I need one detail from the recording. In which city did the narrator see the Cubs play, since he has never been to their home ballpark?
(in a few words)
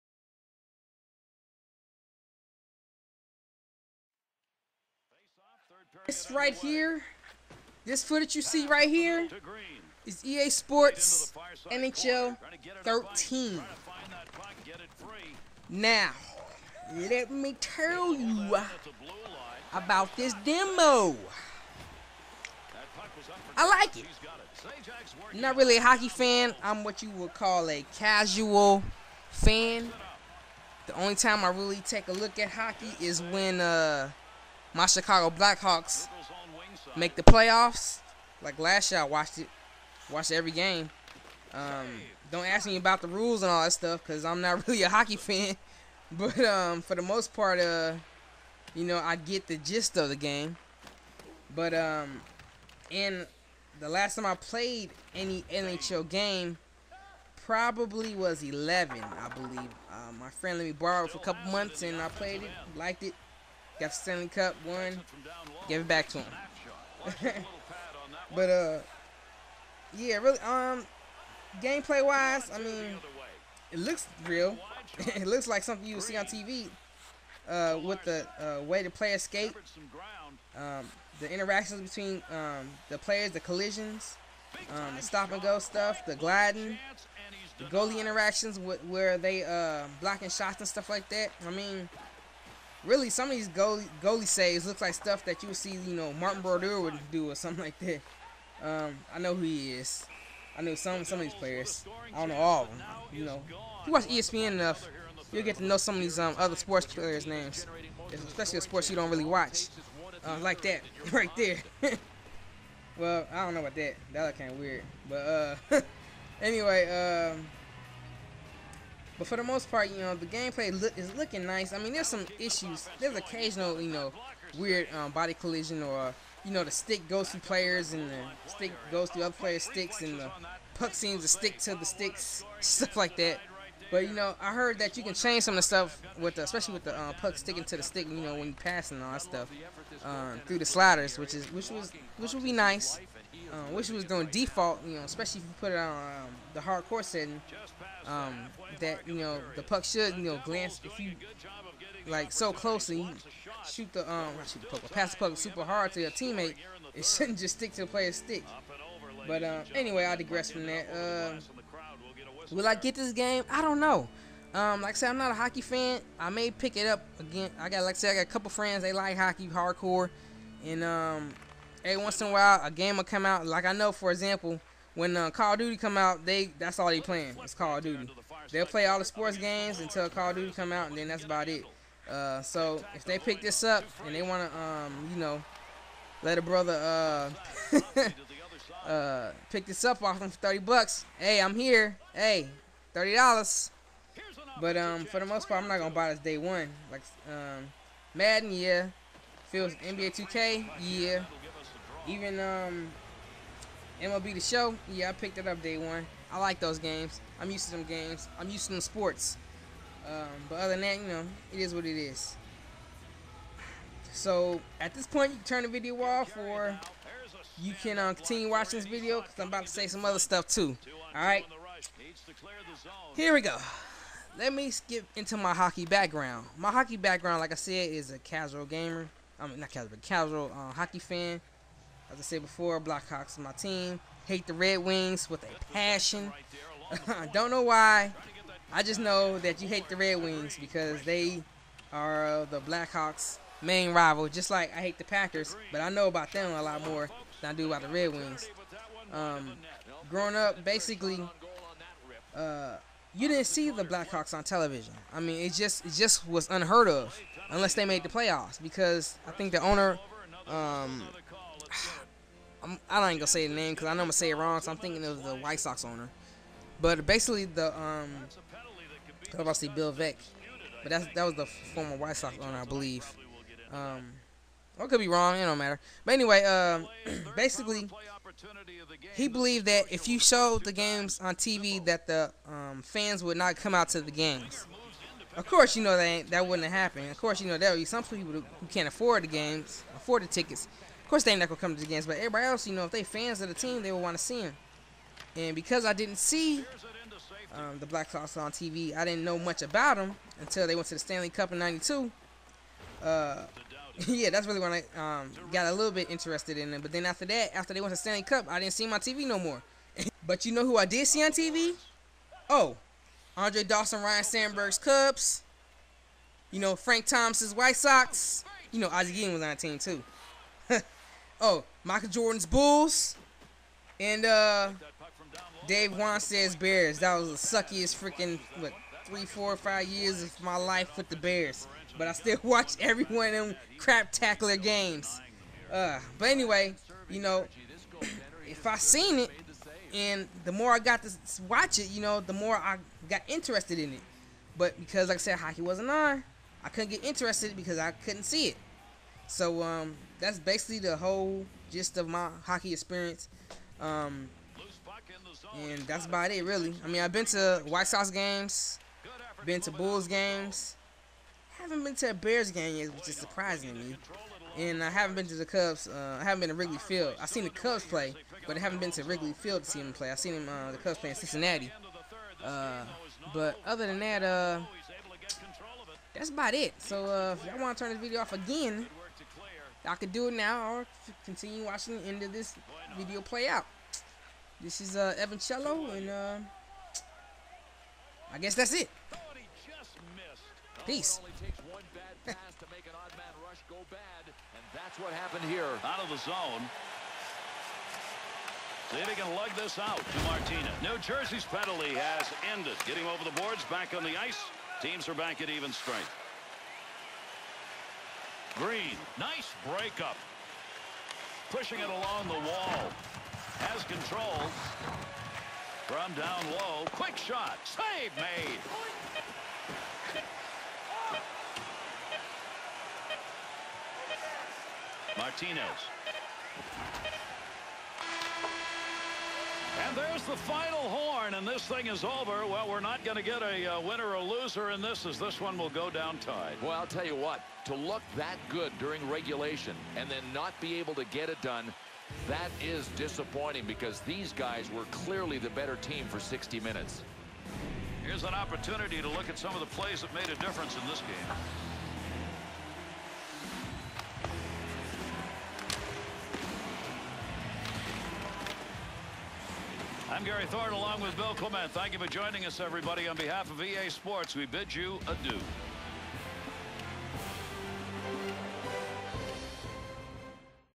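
Cincinnati.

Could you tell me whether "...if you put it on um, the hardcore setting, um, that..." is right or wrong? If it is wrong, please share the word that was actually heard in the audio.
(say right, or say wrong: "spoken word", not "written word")
right.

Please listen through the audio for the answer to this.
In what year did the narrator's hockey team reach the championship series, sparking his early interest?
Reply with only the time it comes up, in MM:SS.
05:01.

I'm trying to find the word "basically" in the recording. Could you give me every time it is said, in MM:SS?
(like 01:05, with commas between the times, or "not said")
04:10, 04:27, 04:37, 05:50.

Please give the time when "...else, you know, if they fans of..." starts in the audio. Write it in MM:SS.
04:52.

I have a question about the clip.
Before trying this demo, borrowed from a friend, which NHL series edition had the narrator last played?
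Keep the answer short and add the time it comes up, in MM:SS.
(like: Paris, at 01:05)
11, at 00:58.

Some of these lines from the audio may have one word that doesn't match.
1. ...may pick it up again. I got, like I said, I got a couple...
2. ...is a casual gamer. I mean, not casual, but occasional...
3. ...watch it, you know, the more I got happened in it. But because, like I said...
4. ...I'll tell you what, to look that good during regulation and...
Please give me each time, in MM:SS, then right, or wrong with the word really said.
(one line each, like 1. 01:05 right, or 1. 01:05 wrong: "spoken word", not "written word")
1. 02:46 right
2. 03:47 wrong: "casual", not "occasional"
3. 05:41 wrong: "interested", not "happened"
4. 07:16 right.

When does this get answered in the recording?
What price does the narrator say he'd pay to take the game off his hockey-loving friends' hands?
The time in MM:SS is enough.
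03:10.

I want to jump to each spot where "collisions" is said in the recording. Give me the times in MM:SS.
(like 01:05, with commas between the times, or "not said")
01:23, 02:05.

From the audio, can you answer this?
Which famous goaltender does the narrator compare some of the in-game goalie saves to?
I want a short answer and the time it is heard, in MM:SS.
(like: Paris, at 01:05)
Martin Brodeur, at 01:36.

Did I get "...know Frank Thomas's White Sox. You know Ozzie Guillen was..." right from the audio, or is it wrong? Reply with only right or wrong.
right.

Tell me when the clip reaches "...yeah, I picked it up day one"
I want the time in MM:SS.
03:24.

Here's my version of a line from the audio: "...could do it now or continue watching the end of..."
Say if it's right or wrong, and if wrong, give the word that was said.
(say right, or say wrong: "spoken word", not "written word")
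right.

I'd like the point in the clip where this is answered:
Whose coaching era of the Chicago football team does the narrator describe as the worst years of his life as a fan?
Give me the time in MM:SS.
05:25.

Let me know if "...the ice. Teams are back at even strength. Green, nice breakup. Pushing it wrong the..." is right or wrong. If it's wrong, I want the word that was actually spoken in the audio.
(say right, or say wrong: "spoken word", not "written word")
wrong: "along", not "wrong".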